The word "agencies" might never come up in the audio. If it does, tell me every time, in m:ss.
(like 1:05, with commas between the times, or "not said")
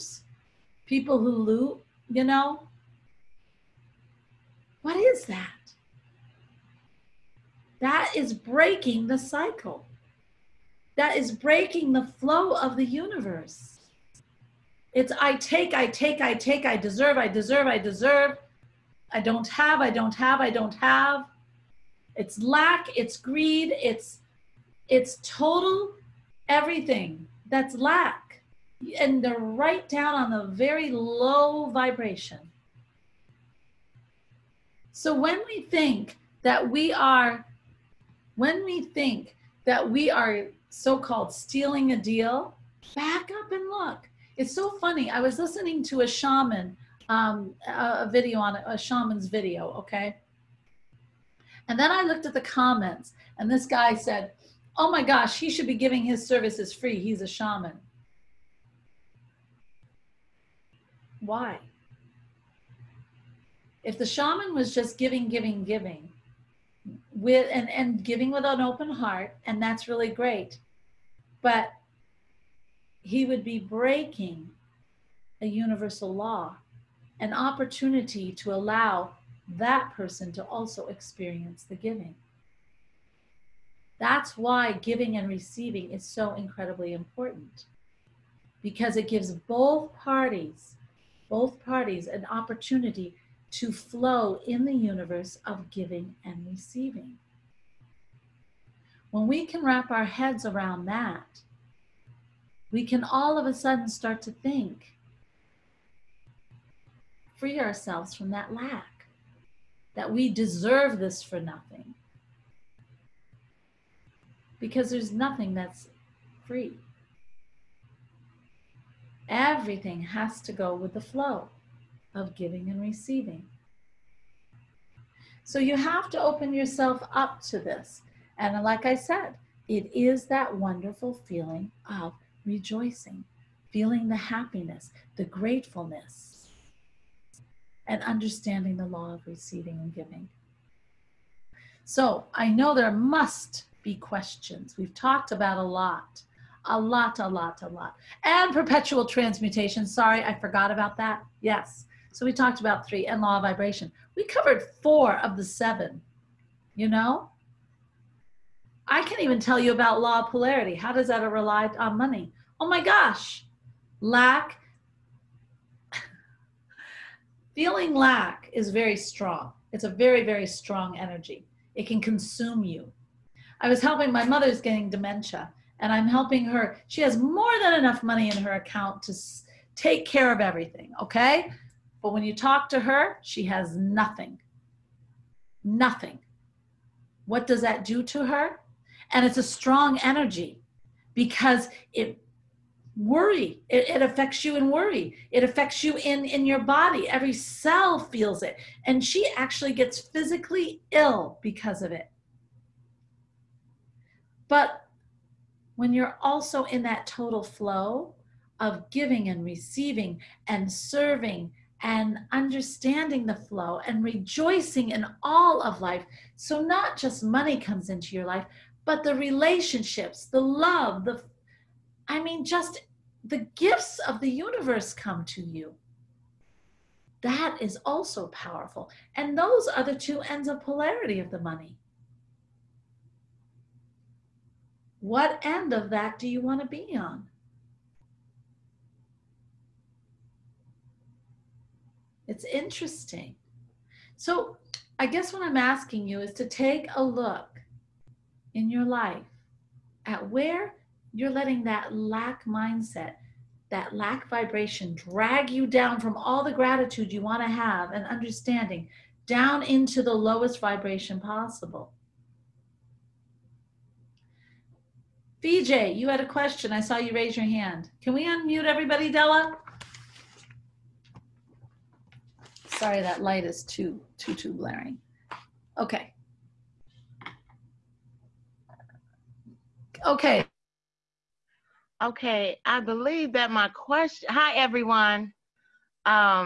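not said.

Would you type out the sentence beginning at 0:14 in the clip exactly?
It's I take, I take, I take, I deserve, I deserve, I deserve.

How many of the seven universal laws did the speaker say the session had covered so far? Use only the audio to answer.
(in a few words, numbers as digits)
4.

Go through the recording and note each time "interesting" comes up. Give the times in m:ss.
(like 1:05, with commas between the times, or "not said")
4:02.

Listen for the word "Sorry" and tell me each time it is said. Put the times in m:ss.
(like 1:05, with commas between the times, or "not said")
2:29, 4:32.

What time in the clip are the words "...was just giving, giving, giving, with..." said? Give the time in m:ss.
1:04.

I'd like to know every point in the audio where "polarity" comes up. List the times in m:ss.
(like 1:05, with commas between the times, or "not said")
2:40, 3:50.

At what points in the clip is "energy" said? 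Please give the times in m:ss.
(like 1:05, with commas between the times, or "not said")
2:50, 3:09.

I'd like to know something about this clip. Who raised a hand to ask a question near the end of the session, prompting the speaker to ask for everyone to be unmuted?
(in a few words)
VJ.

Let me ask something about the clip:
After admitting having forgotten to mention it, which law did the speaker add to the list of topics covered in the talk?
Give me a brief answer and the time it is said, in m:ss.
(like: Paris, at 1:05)
perpetual transmutation, at 2:28.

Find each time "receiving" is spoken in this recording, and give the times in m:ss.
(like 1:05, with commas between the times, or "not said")
1:25, 1:36, 2:02, 2:19, 3:29.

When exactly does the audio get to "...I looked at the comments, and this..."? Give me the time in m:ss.
0:51.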